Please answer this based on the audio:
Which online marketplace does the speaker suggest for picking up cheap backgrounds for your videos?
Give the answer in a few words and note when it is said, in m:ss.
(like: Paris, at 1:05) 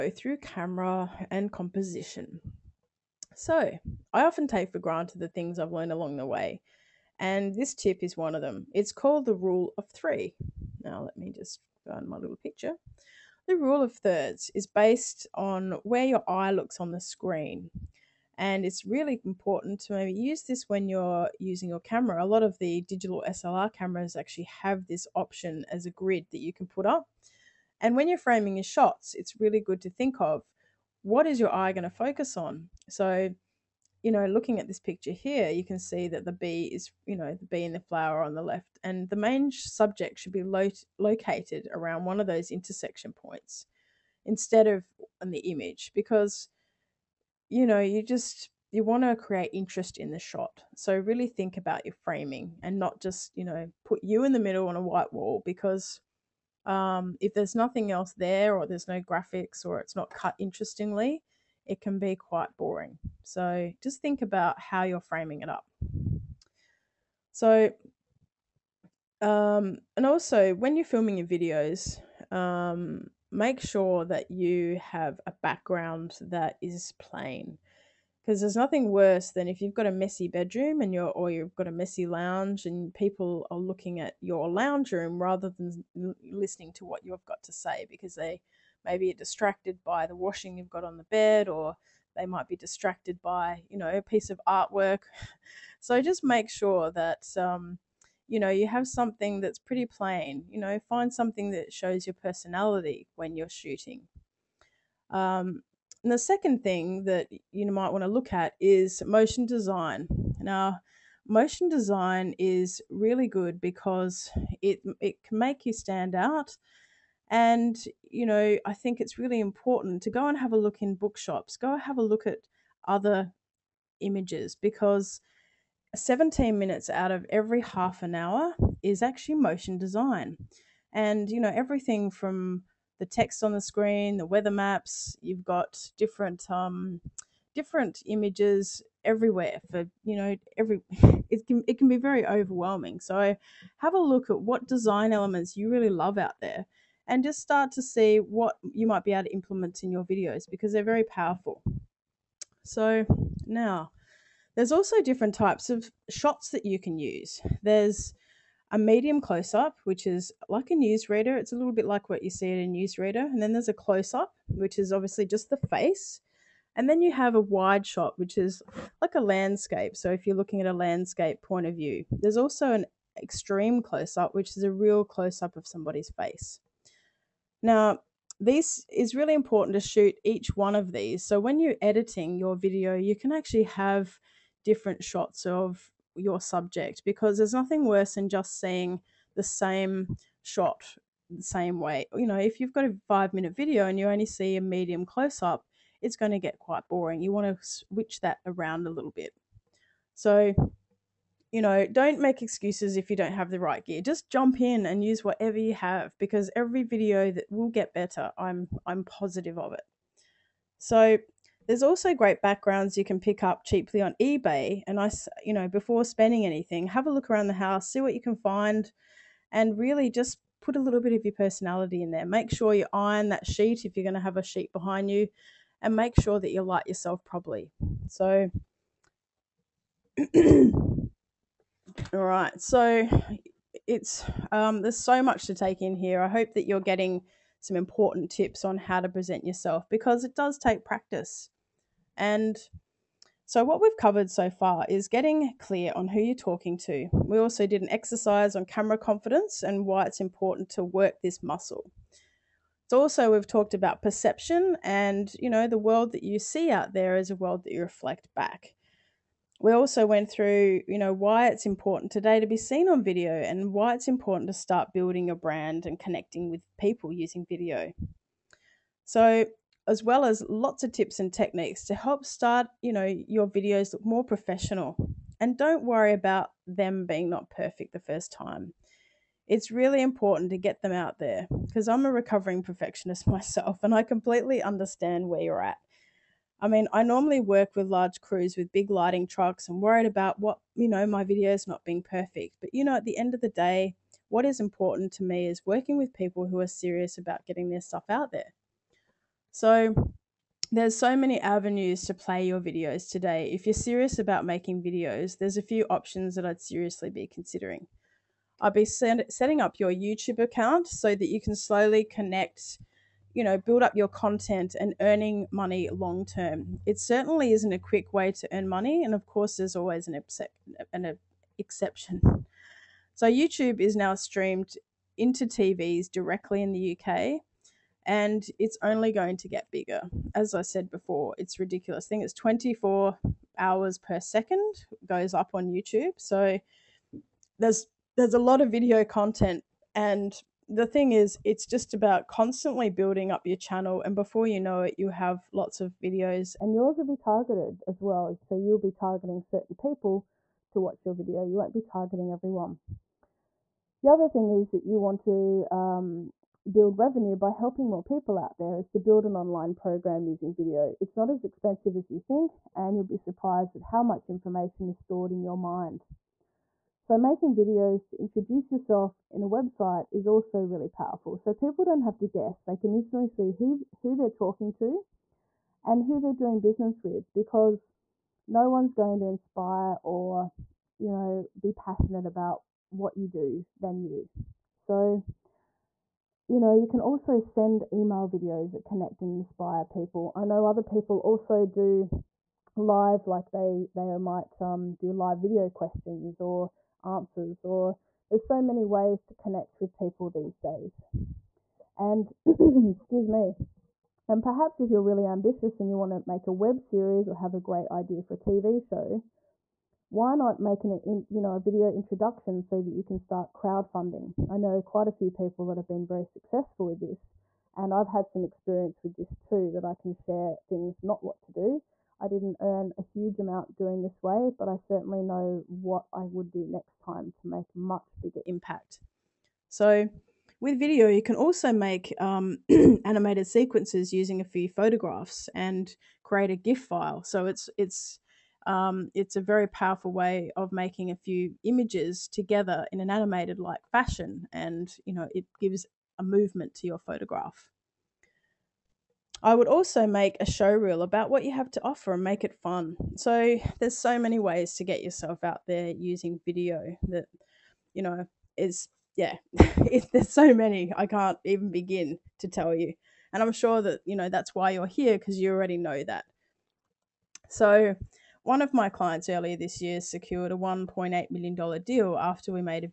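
eBay, at 3:34.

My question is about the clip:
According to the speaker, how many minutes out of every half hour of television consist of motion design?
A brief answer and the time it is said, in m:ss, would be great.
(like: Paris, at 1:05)
17, at 2:05.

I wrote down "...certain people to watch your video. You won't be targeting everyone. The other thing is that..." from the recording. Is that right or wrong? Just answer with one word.
right.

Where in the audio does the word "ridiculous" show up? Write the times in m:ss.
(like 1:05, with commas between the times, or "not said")
5:31.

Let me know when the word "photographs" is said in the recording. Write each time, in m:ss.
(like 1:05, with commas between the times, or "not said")
7:14, 7:26.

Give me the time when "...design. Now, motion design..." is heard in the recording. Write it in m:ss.
1:49.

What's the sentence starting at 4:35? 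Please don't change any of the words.
And don't worry about them being not perfect the first time.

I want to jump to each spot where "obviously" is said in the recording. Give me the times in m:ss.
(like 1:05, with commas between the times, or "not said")
2:44.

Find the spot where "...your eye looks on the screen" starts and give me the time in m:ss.
0:16.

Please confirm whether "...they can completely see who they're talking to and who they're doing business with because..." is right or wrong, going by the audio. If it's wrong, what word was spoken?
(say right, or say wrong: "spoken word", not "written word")
wrong: "instantly", not "completely".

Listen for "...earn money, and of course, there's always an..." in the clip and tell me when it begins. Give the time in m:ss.
5:18.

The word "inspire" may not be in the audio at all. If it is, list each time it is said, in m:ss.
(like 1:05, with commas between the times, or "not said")
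6:19, 6:29.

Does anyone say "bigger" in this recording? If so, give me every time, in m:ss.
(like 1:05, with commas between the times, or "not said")
5:29, 7:08.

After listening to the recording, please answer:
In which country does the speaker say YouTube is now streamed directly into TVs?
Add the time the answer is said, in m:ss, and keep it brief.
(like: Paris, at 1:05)
UK, at 5:26.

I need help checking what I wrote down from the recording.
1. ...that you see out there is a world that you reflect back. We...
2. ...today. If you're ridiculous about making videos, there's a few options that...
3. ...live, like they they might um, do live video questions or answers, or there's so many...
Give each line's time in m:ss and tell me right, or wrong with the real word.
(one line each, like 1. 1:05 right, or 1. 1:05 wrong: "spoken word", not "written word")
1. 4:16 right
2. 5:03 wrong: "serious", not "ridiculous"
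3. 6:32 right.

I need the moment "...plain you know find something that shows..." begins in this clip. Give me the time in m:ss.
1:39.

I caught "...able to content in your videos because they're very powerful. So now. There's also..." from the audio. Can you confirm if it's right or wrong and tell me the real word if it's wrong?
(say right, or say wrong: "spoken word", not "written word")
wrong: "implement", not "content".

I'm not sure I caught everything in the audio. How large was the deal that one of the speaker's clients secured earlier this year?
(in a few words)
$1.8 million.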